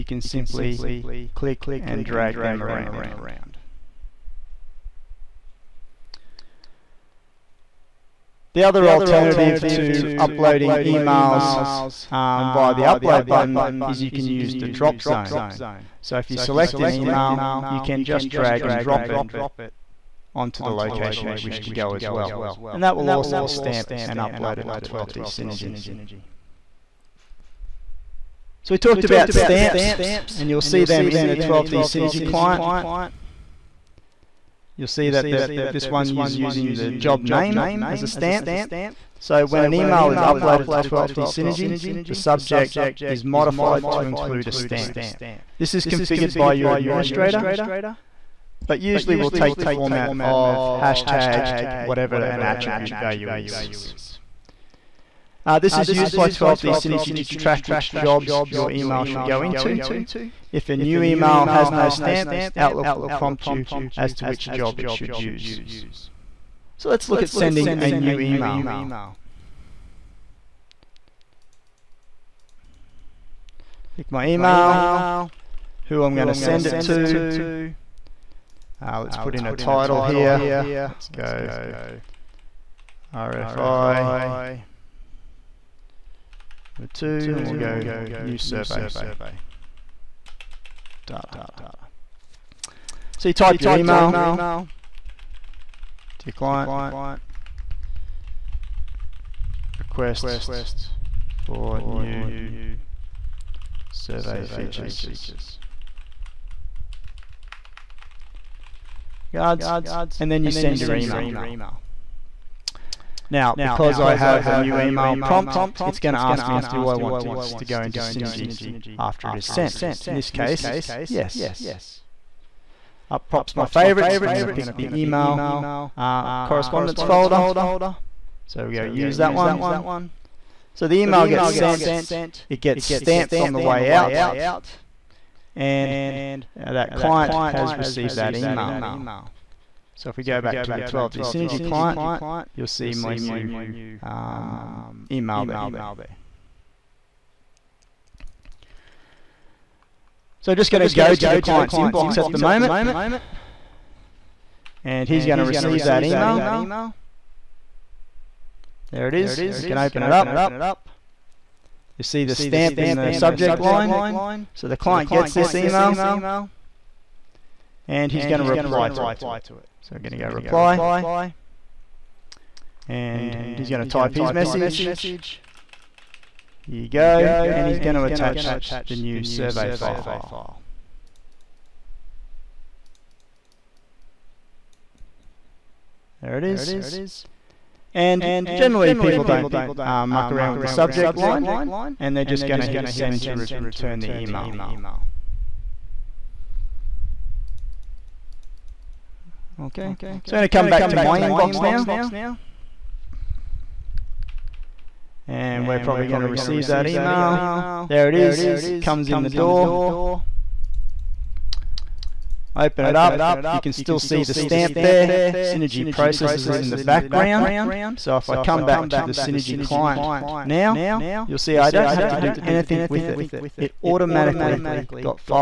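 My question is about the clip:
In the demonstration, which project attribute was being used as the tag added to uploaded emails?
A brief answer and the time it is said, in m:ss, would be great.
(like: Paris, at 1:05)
Job name, at 0:36.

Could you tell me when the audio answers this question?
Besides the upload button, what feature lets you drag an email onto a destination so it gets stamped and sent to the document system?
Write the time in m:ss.
0:14.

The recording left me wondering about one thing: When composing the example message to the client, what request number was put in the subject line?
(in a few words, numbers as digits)
RFI number 2.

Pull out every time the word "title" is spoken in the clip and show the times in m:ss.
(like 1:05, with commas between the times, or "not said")
1:19.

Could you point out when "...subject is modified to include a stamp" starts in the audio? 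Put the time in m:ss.
0:42.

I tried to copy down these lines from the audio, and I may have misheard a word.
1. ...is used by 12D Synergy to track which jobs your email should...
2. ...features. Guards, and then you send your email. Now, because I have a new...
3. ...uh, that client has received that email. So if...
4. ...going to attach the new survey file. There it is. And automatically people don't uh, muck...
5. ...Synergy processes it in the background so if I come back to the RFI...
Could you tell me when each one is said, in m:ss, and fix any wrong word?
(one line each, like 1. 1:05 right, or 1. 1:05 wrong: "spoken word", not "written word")
1. 0:55 right
2. 1:44 right
3. 2:16 right
4. 2:57 wrong: "generally", not "automatically"
5. 3:35 wrong: "Synergy", not "RFI".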